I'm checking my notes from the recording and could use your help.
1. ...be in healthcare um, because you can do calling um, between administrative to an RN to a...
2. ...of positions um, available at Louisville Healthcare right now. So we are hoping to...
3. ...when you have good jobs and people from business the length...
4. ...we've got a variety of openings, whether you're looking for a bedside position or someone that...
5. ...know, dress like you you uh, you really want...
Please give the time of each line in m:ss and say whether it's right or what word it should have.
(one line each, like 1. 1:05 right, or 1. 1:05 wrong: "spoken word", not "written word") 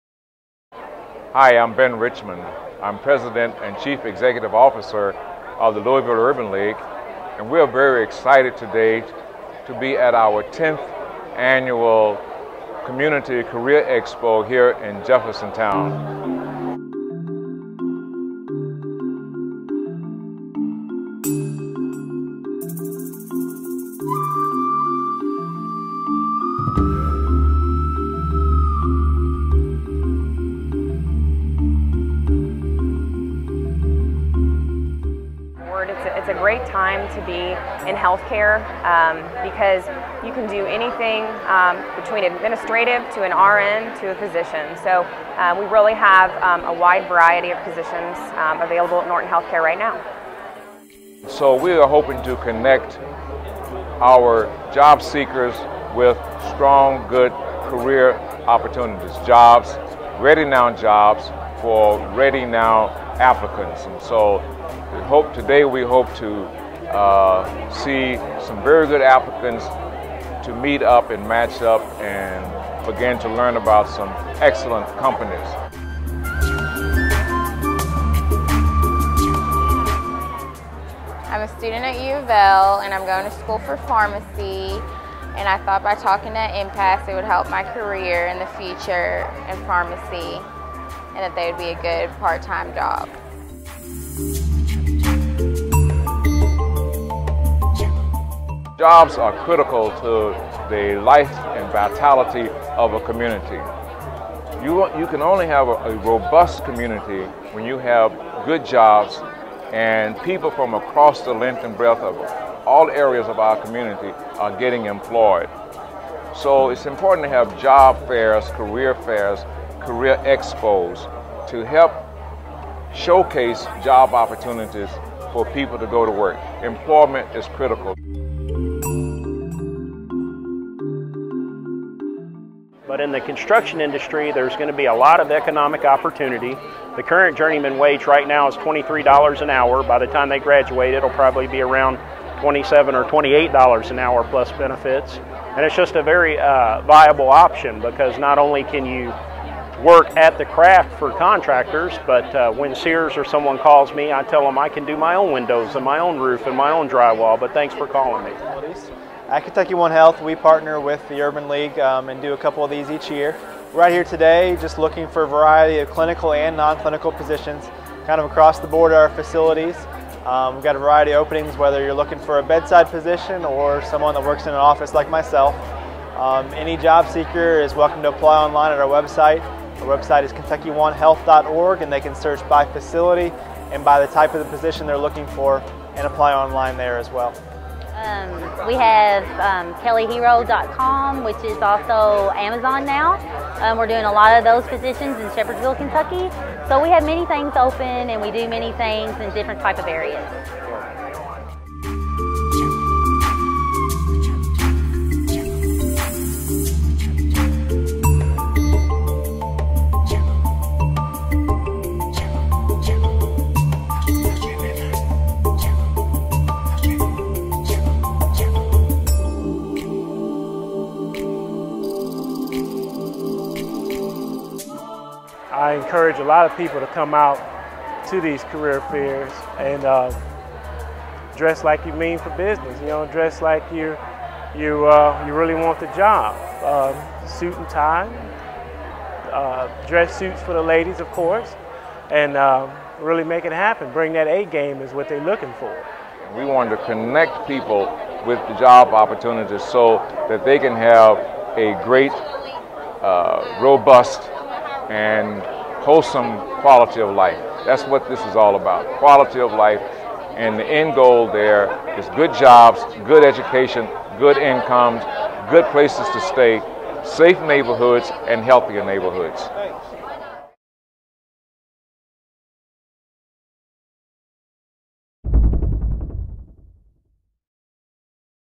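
1. 0:37 wrong: "anything", not "calling"
2. 0:47 wrong: "Norton", not "Louisville"
3. 1:47 wrong: "across", not "business"
4. 2:50 right
5. 3:52 right.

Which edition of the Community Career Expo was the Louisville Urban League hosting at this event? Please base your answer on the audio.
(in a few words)
10th.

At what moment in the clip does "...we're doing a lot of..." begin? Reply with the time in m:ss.
3:13.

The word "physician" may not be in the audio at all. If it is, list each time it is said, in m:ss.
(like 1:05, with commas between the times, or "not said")
0:44.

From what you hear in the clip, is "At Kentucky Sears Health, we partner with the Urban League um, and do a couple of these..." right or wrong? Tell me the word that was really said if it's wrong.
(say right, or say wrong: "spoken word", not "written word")
wrong: "One", not "Sears".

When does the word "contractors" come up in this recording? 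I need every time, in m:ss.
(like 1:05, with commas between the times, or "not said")
2:31.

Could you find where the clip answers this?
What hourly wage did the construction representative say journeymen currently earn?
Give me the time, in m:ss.
2:18.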